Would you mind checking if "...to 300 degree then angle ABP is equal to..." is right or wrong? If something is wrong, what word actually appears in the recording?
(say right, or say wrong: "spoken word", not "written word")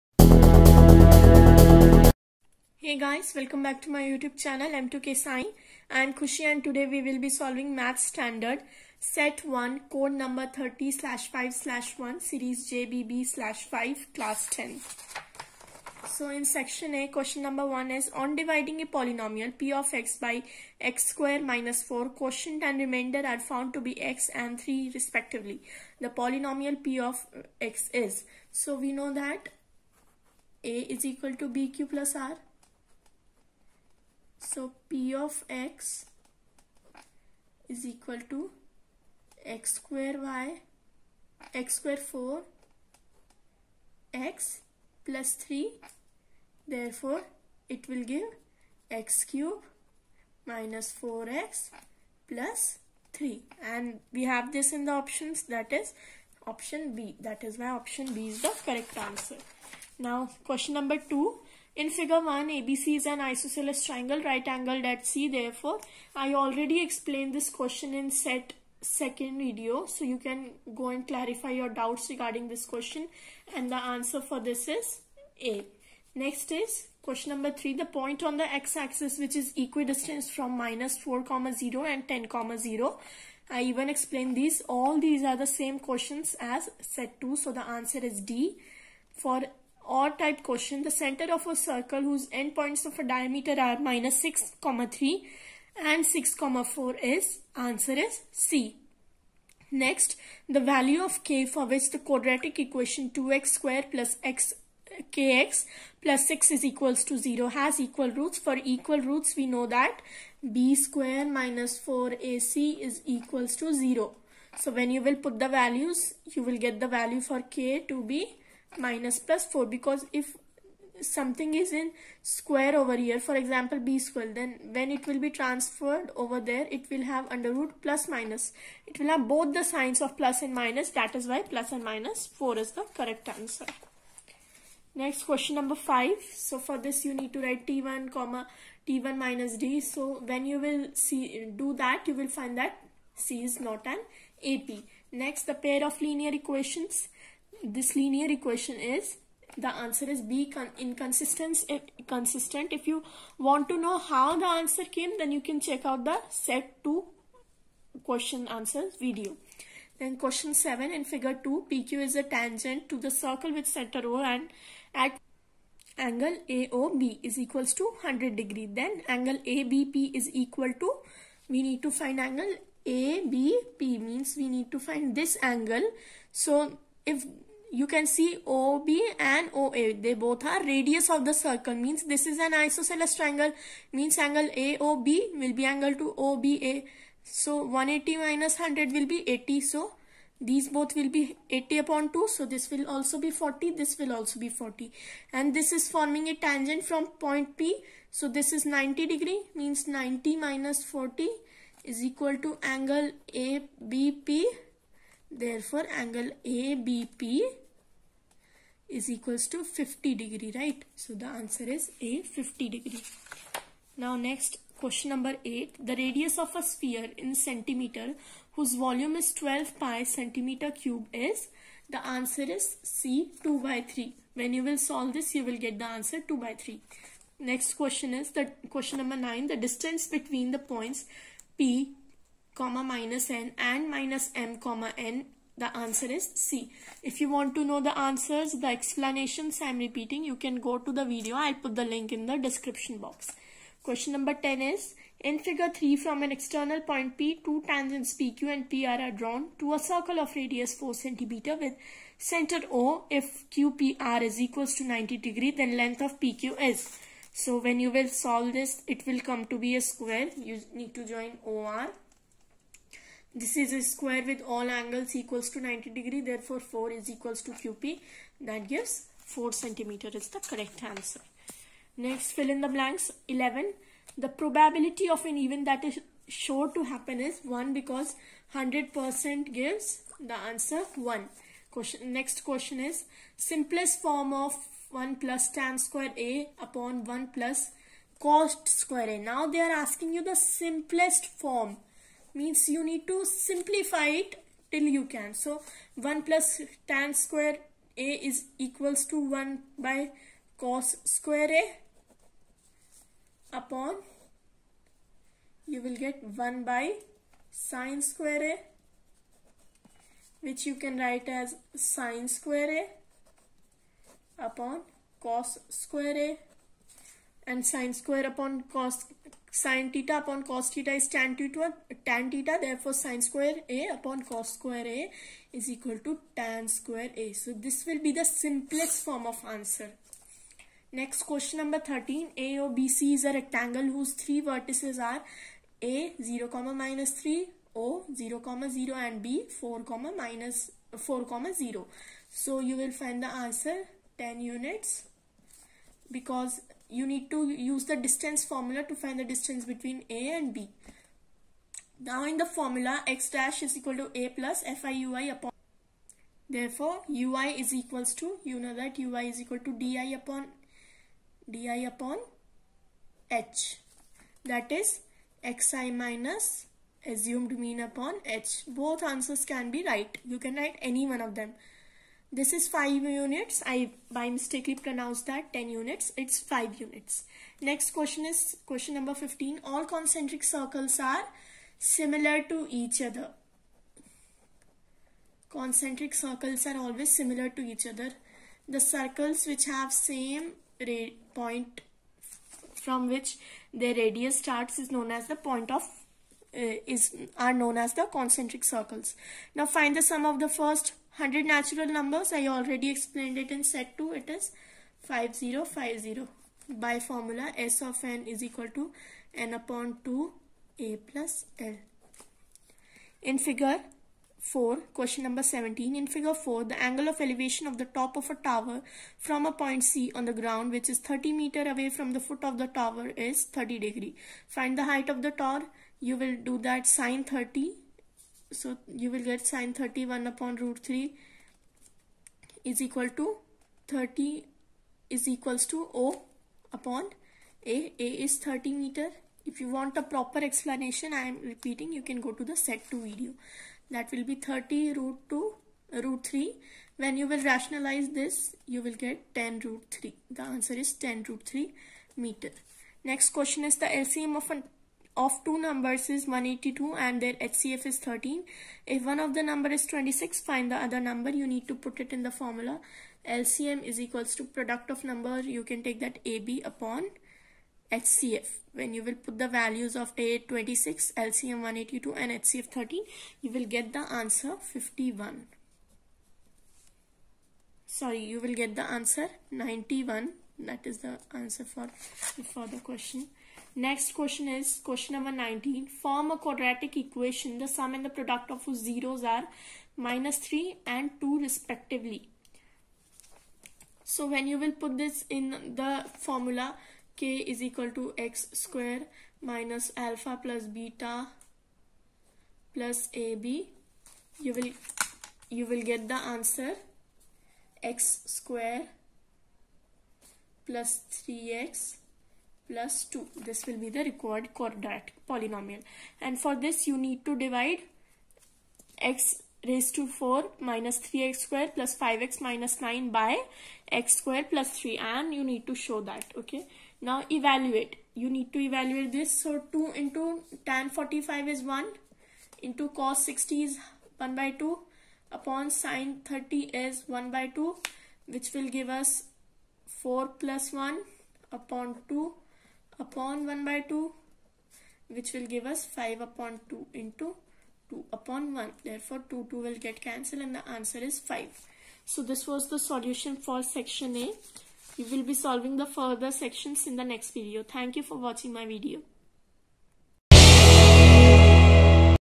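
wrong: "100", not "300".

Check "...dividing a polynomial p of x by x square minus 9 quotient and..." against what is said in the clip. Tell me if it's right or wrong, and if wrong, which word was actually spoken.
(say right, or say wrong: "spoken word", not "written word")
wrong: "4", not "9".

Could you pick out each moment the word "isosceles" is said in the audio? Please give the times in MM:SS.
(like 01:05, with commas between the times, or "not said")
01:03, 03:02.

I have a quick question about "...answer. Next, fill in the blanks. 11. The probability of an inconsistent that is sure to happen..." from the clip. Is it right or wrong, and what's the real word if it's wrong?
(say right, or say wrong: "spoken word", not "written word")
wrong: "event", not "inconsistent".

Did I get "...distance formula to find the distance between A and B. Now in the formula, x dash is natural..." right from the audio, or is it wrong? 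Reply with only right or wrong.
wrong.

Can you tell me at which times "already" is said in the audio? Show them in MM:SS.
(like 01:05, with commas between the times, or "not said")
01:06, 06:42.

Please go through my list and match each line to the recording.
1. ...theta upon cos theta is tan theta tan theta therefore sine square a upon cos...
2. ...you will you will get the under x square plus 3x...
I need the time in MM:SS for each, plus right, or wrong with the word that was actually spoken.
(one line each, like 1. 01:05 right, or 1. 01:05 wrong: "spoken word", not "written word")
1. 05:19 right
2. 08:24 wrong: "answer", not "under".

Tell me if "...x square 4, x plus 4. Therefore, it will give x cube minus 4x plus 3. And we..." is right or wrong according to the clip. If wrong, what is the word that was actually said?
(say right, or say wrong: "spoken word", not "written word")
wrong: "3", not "4".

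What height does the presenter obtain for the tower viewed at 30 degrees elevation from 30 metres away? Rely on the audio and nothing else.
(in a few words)
10 root 3 metres.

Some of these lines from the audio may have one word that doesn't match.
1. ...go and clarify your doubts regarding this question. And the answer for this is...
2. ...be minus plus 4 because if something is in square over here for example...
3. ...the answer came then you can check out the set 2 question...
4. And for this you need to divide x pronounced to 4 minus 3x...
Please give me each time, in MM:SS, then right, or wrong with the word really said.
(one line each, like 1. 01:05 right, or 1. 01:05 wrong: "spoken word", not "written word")
1. 01:10 right
2. 01:58 right
3. 02:34 right
4. 08:36 wrong: "raised", not "pronounced".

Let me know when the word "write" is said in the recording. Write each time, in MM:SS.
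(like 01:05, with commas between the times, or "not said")
02:17, 05:10, 06:10.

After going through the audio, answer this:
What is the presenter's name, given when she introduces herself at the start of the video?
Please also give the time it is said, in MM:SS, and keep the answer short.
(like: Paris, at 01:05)
Kushi, at 00:06.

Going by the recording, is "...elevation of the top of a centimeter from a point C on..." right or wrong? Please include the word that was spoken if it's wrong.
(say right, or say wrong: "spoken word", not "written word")
wrong: "tower", not "centimeter".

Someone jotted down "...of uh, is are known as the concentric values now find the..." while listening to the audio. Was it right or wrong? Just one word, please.
wrong.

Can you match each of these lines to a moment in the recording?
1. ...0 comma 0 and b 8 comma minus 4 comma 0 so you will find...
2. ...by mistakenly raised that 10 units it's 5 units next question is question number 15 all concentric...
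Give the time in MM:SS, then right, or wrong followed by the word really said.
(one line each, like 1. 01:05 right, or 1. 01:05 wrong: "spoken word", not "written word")
1. 05:38 wrong: "4", not "8"
2. 06:14 wrong: "pronounced", not "raised".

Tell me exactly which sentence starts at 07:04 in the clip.
Find the height of the tower.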